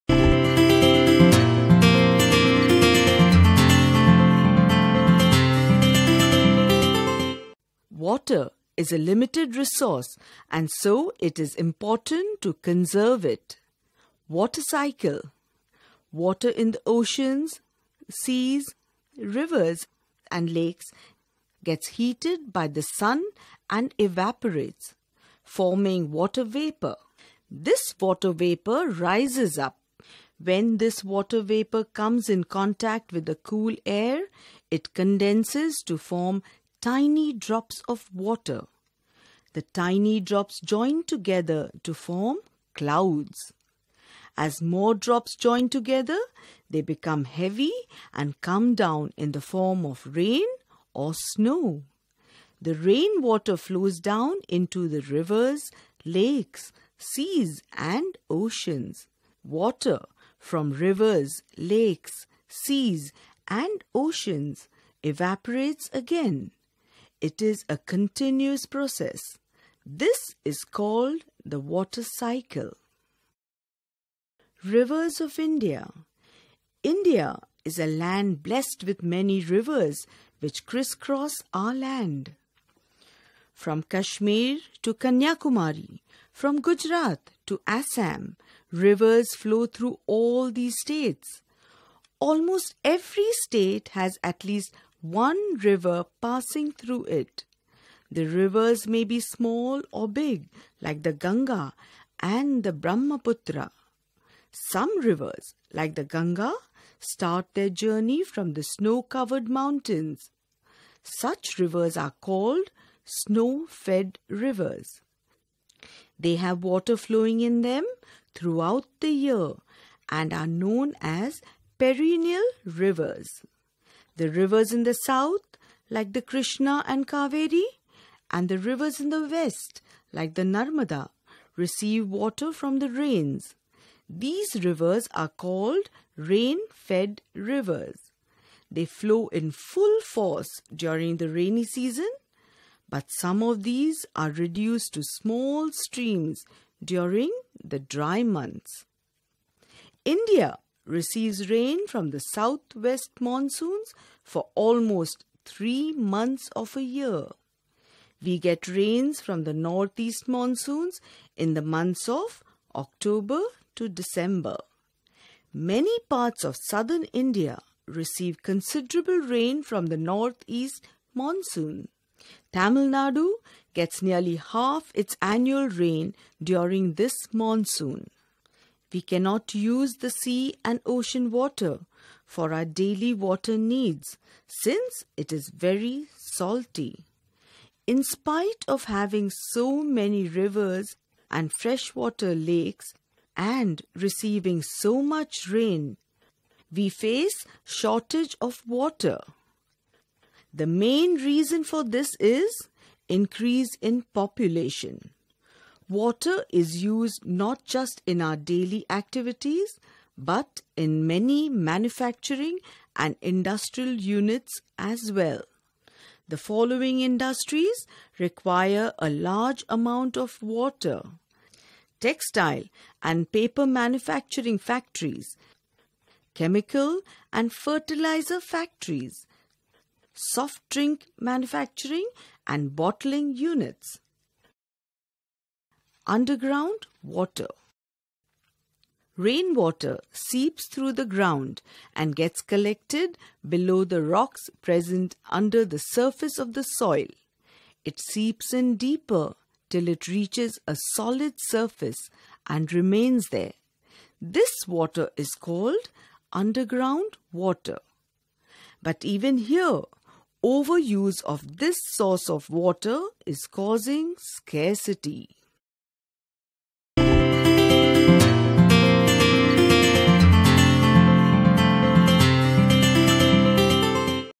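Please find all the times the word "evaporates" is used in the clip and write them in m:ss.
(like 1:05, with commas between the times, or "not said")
0:23, 1:05.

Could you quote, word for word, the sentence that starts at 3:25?
Water is used not just in our daily activities but in many manufacturing and industrial units as well.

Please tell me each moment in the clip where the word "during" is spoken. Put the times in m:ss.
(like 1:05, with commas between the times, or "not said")
2:20, 2:26, 2:56.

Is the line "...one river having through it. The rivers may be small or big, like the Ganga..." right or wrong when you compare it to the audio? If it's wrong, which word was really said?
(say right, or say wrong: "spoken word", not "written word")
wrong: "passing", not "having".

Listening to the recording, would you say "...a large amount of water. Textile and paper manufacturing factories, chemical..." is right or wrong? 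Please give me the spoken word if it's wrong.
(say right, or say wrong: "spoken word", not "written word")
right.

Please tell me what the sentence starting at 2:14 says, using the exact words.
These rivers are called rain fed rivers.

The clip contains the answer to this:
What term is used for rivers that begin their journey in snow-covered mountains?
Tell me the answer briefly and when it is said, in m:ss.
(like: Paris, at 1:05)
snow fed rivers, at 1:53.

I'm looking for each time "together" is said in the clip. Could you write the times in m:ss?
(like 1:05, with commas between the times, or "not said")
0:41, 0:45.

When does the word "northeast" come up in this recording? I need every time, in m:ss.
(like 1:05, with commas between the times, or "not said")
2:39, 2:49.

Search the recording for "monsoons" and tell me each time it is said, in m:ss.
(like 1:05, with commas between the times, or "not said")
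2:33, 2:40, 2:51, 2:57.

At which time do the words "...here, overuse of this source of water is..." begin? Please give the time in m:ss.
4:19.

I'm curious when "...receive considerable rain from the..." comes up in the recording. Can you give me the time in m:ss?
2:47.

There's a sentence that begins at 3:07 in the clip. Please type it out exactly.
In spite of having so many rivers and freshwater lakes and receiving so much rain, we face shortage of water.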